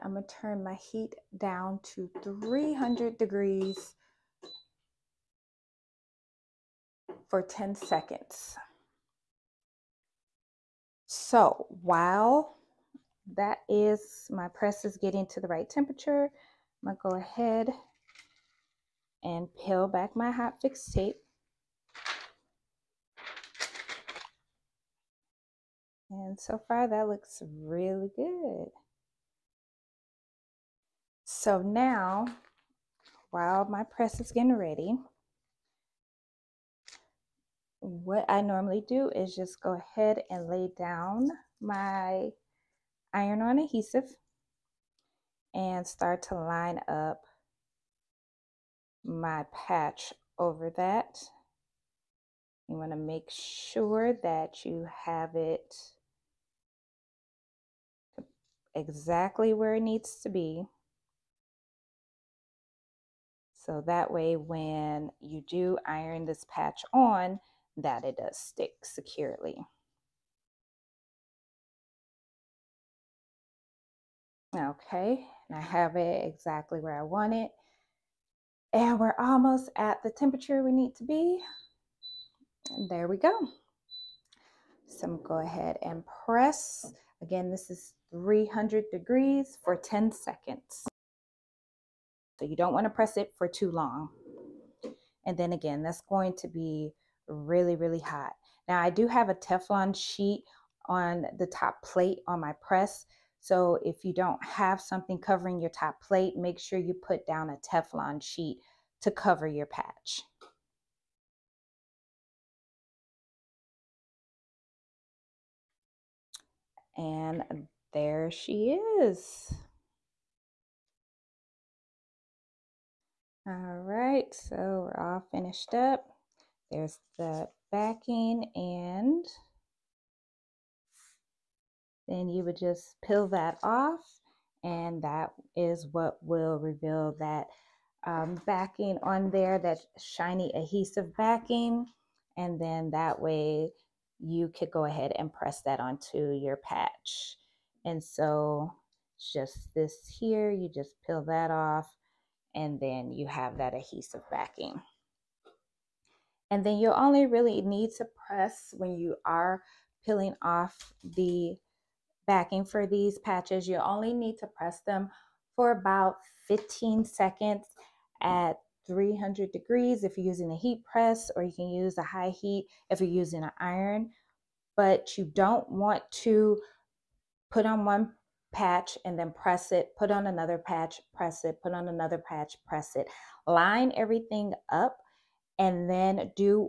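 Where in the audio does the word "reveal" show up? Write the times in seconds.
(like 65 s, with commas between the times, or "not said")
136 s.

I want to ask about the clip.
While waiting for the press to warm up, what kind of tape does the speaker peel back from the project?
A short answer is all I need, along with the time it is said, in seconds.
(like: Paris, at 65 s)
hot fix tape, at 20 s.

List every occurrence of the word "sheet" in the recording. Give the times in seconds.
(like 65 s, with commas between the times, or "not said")
99 s, 108 s.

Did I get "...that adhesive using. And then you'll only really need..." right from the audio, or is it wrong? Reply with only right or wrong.
wrong.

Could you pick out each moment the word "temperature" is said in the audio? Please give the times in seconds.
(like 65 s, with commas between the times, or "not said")
15 s, 80 s.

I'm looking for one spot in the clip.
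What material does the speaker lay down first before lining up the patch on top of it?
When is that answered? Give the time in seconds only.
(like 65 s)
43 s.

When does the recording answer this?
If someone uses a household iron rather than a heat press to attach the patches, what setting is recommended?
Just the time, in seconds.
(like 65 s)
172 s.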